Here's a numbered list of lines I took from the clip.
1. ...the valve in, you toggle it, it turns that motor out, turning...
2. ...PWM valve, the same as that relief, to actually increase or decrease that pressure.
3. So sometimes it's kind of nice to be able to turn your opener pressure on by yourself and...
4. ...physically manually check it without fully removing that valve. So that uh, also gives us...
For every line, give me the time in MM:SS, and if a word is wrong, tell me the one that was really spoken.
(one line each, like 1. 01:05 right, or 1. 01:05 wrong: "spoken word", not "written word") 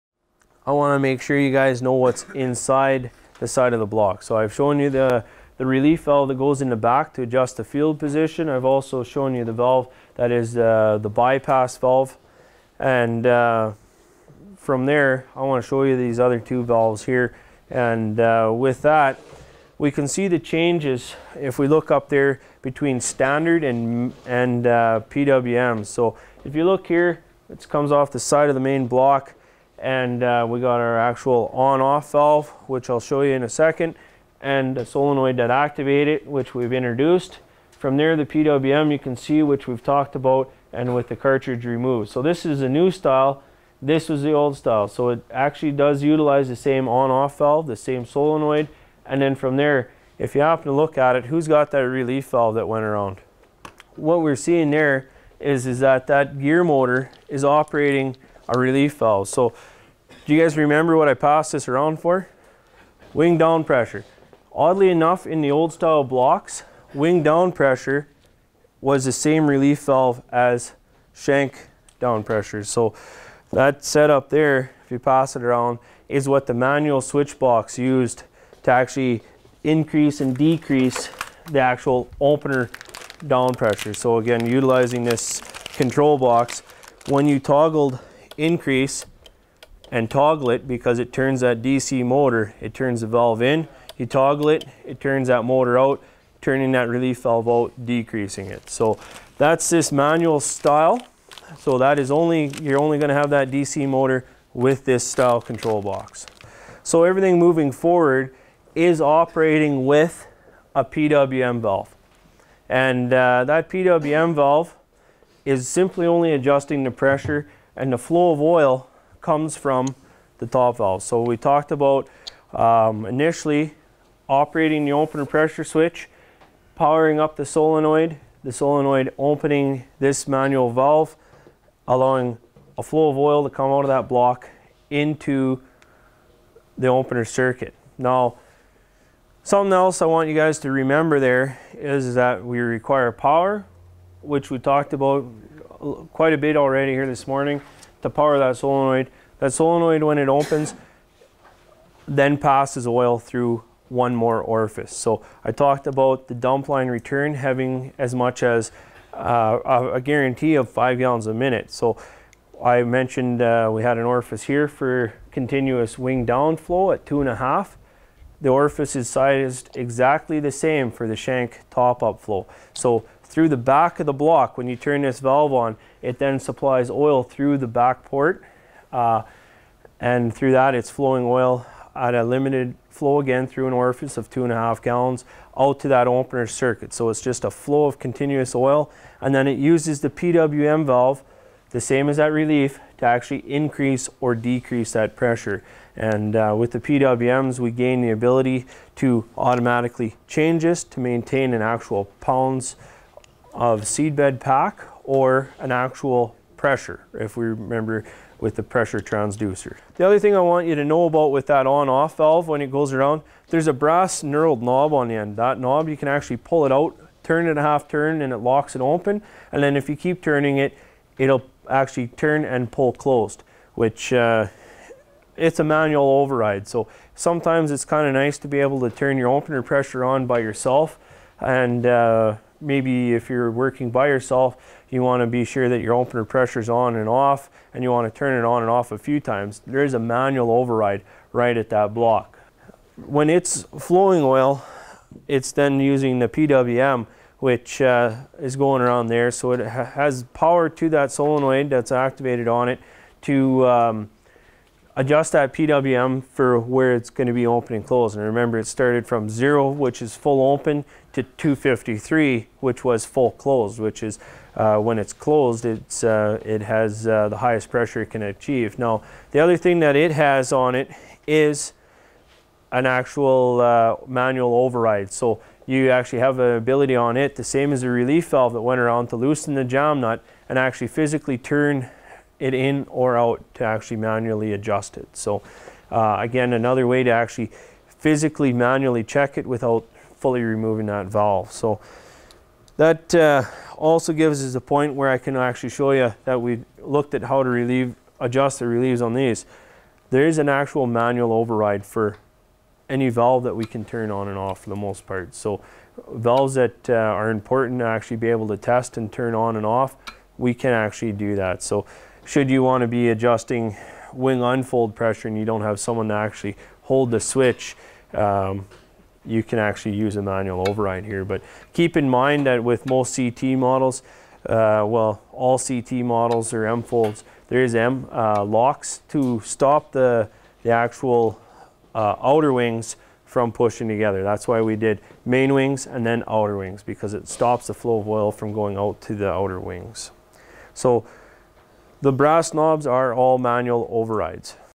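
1. 01:33 right
2. 03:10 right
3. 03:46 right
4. 04:47 right.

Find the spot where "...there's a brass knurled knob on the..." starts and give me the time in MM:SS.
03:33.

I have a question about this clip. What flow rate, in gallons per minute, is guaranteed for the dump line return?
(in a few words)
5.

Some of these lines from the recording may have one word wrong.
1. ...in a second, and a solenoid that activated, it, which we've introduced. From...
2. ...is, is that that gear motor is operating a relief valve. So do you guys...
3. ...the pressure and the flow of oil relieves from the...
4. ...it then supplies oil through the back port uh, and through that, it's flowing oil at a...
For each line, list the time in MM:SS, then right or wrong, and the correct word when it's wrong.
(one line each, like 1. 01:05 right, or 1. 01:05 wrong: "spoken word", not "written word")
1. 00:33 right
2. 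00:55 right
3. 01:56 wrong: "comes", not "relieves"
4. 02:56 right.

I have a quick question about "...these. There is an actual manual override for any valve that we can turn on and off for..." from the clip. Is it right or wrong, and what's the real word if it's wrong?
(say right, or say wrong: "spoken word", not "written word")
right.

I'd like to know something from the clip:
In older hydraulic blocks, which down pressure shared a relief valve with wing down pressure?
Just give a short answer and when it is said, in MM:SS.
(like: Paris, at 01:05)
Shank down pressure, at 01:11.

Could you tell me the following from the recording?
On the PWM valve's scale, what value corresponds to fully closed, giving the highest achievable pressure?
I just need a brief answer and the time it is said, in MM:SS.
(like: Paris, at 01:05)
253, at 04:21.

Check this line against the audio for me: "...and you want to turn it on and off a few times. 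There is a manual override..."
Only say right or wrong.
right.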